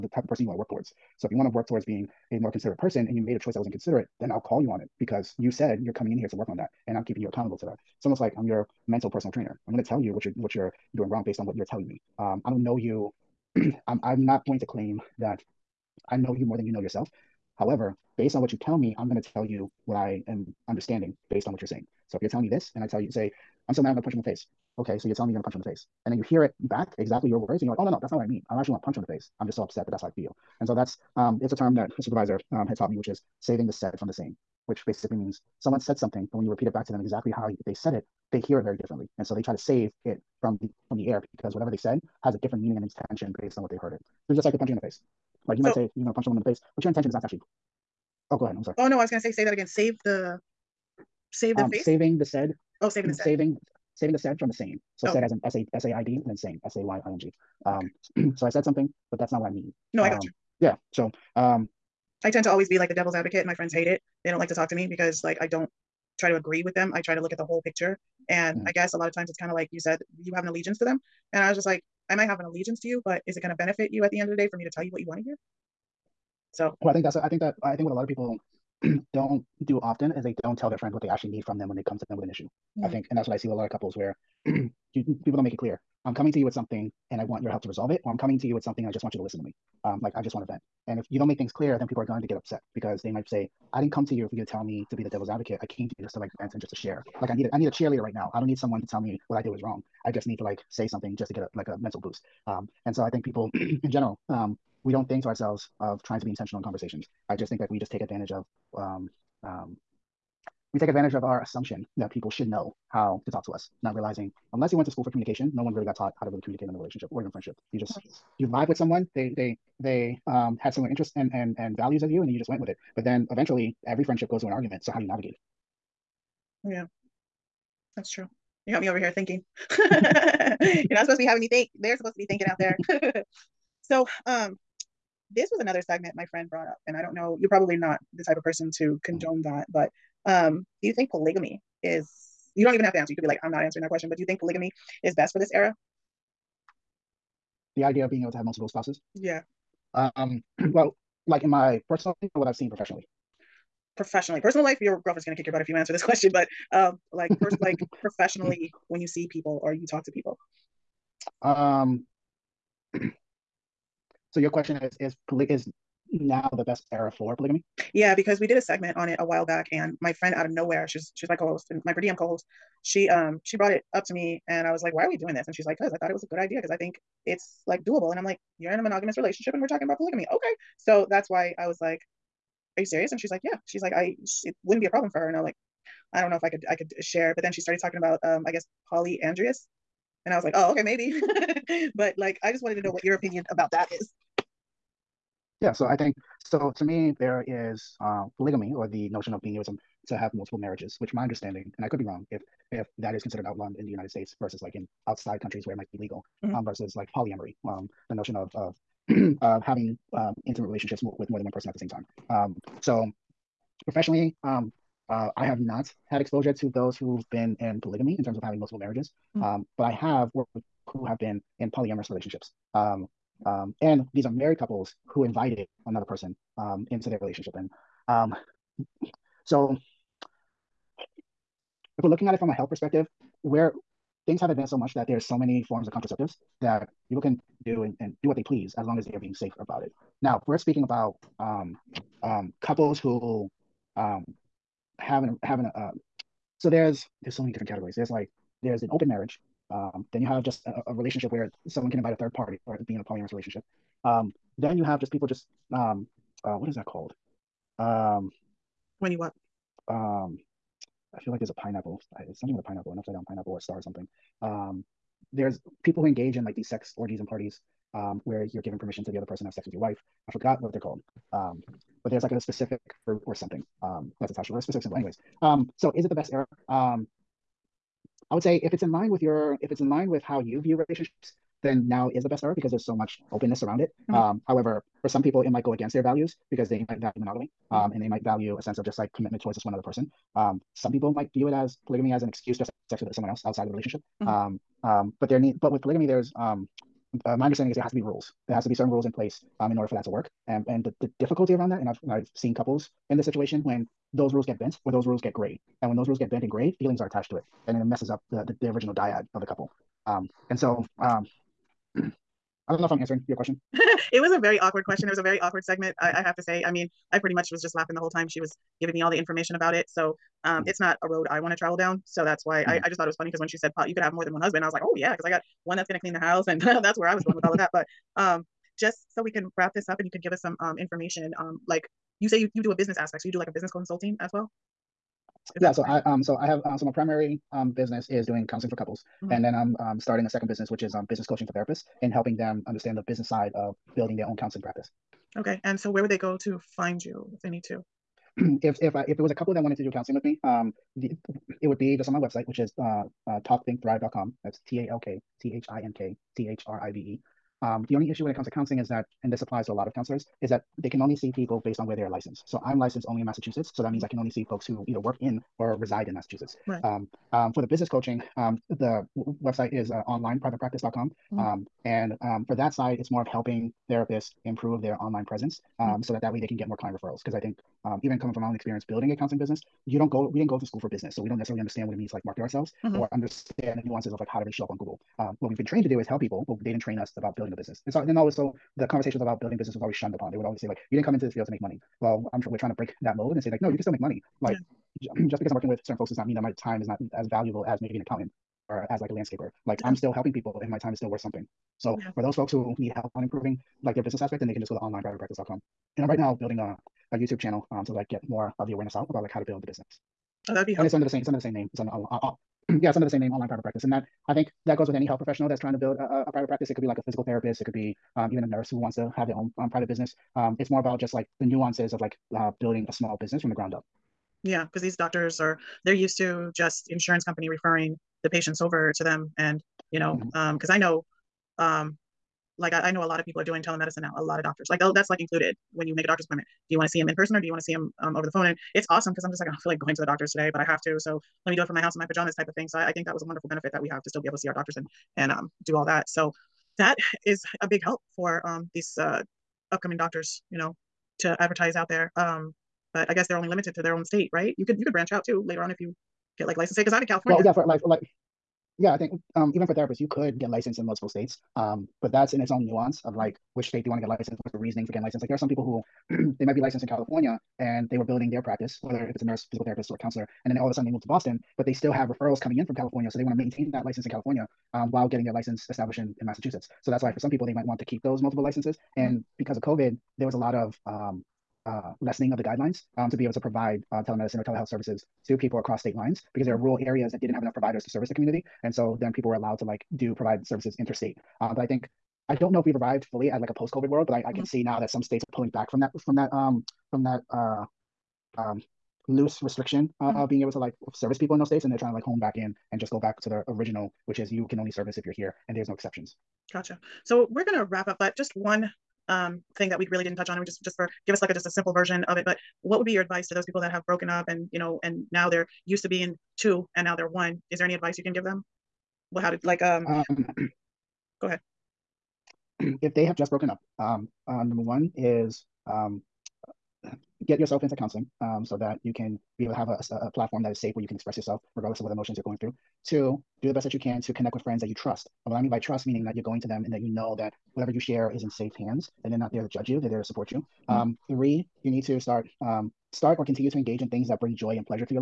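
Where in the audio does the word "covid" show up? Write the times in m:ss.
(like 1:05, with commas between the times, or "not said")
7:59, 8:13.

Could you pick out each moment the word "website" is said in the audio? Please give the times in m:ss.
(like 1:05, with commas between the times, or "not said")
5:52, 6:09.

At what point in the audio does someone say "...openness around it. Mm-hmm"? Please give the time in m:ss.
4:43.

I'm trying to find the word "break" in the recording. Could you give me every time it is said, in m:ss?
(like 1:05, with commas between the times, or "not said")
6:32.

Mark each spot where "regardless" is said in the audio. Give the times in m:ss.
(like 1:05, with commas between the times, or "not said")
8:51.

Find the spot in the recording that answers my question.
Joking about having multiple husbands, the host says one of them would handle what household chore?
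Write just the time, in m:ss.
5:26.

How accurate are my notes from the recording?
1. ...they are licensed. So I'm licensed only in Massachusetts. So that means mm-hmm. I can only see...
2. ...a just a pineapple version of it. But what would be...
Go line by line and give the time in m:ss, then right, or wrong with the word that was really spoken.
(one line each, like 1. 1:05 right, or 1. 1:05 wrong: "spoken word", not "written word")
1. 6:01 right
2. 8:31 wrong: "simple", not "pineapple".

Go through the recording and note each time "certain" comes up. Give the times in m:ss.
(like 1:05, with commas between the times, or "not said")
4:58, 6:35.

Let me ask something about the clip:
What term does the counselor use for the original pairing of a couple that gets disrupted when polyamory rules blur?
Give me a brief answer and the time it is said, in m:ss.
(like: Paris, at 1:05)
dyad, at 5:08.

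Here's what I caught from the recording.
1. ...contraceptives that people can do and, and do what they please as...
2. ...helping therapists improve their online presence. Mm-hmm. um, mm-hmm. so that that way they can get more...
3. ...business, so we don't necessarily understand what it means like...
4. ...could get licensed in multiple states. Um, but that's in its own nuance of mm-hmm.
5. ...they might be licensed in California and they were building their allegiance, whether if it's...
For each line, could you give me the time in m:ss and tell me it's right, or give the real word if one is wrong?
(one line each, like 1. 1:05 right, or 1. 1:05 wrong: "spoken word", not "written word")
1. 3:55 right
2. 6:13 right
3. 6:20 right
4. 7:40 right
5. 7:46 wrong: "practice", not "allegiance".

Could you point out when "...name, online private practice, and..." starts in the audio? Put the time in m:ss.
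6:53.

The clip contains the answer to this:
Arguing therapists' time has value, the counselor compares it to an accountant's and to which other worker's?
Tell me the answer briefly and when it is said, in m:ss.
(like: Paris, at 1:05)
landscaper, at 6:39.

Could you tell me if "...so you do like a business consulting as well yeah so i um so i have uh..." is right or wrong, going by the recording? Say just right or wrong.
right.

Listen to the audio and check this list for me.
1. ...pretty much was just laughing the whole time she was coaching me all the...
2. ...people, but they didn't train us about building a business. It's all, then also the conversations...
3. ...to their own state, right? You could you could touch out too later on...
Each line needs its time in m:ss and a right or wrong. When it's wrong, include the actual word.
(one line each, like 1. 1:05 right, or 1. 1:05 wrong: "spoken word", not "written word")
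1. 5:17 wrong: "giving", not "coaching"
2. 6:26 right
3. 7:33 wrong: "branch", not "touch".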